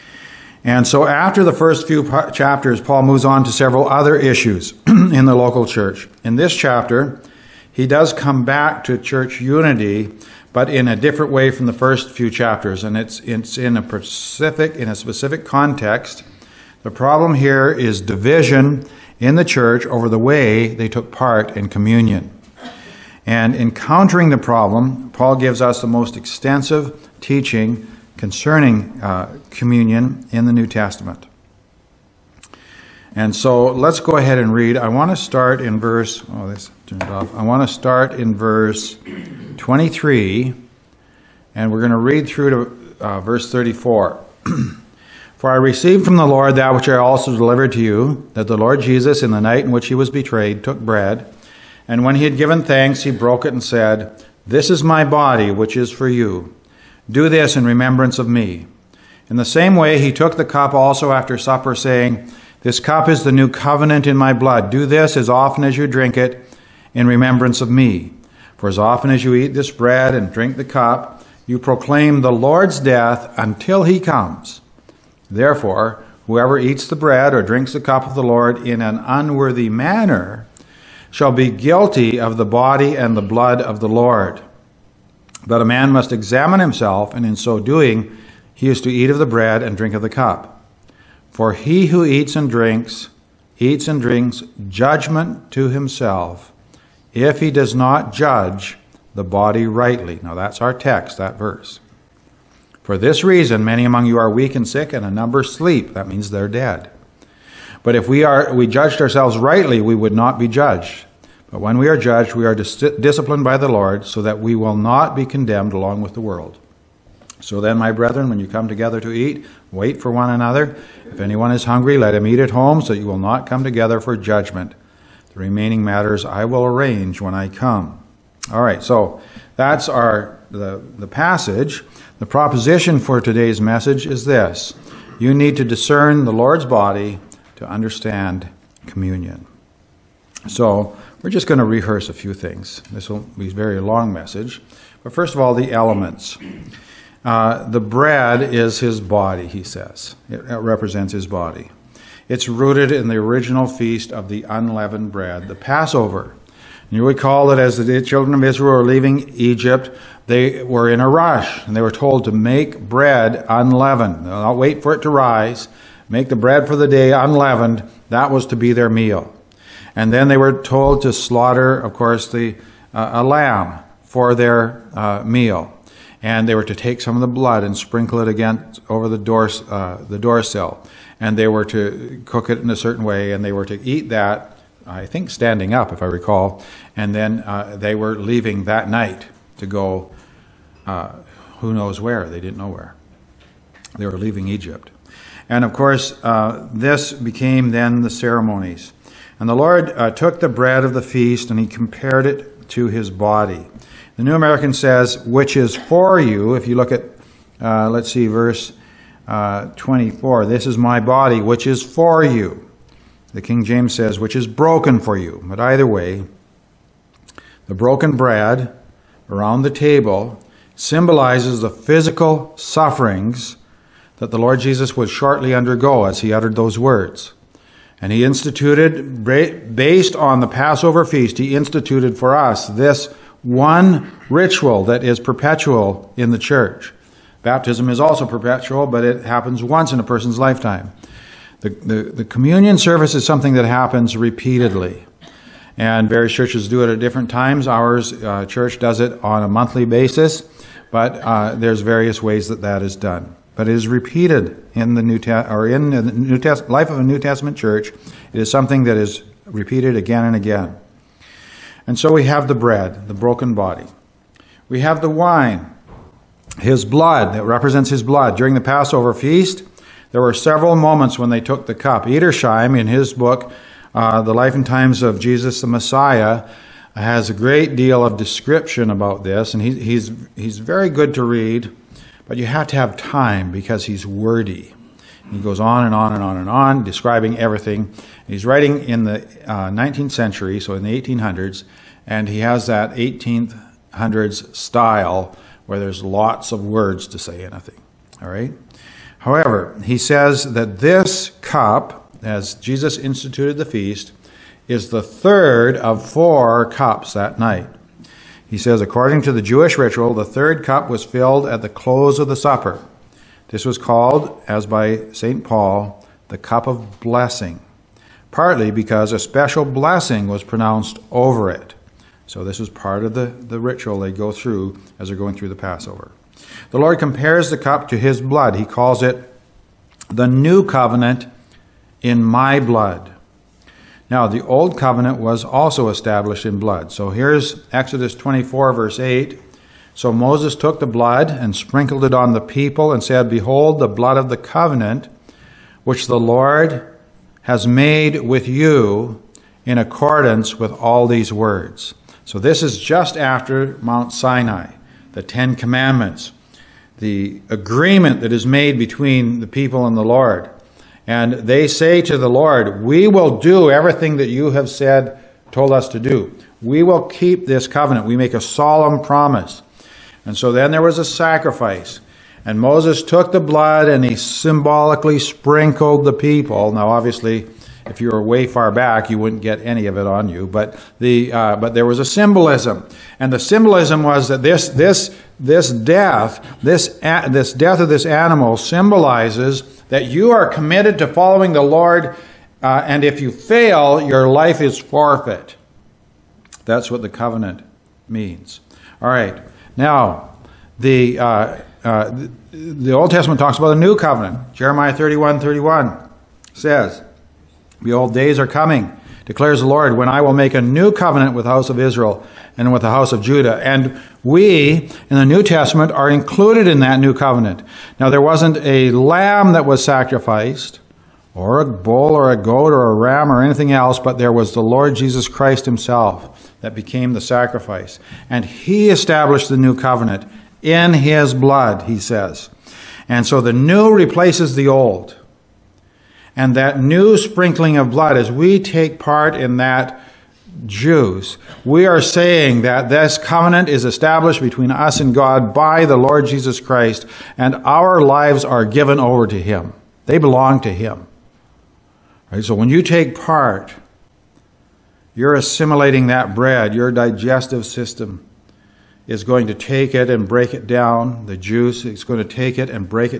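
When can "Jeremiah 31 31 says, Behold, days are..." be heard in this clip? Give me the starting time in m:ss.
6:44.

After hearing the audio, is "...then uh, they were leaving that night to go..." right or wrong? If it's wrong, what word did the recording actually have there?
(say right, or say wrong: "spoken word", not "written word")
right.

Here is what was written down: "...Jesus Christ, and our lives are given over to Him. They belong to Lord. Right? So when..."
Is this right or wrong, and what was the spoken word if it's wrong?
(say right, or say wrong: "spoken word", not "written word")
wrong: "Him", not "Lord".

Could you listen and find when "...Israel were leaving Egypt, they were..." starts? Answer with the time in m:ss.
2:38.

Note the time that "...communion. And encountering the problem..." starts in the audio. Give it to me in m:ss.
0:21.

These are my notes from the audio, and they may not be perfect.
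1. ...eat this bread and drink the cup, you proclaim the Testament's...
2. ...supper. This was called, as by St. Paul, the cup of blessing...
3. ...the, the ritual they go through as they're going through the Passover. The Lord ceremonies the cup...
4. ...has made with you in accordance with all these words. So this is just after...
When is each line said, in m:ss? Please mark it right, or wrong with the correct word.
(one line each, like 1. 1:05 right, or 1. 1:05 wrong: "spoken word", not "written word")
1. 1:09 wrong: "Lord", not "Testament"
2. 5:12 right
3. 5:23 wrong: "compares", not "ceremonies"
4. 5:47 right.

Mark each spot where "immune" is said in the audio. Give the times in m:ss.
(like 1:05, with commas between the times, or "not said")
not said.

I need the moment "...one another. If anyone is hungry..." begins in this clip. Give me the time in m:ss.
2:00.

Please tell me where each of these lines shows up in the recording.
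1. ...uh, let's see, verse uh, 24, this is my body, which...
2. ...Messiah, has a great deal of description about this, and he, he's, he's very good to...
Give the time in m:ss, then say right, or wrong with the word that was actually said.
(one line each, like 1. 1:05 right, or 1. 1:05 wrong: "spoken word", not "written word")
1. 3:27 right
2. 4:35 right.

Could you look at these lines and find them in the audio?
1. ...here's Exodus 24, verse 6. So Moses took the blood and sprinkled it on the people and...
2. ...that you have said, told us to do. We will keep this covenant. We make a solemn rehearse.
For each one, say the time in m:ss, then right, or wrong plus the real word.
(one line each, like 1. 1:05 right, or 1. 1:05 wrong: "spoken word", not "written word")
1. 5:37 wrong: "8", not "6"
2. 6:04 wrong: "promise", not "rehearse".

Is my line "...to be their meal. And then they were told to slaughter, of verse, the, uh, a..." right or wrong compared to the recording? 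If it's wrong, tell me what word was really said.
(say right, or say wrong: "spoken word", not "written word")
wrong: "course", not "verse".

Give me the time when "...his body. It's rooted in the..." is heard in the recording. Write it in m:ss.
2:31.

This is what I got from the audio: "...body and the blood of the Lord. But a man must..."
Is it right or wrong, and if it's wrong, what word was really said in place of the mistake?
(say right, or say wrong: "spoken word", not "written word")
right.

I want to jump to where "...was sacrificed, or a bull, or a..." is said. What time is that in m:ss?
6:59.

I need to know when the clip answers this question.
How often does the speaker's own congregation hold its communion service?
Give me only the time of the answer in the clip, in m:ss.
4:09.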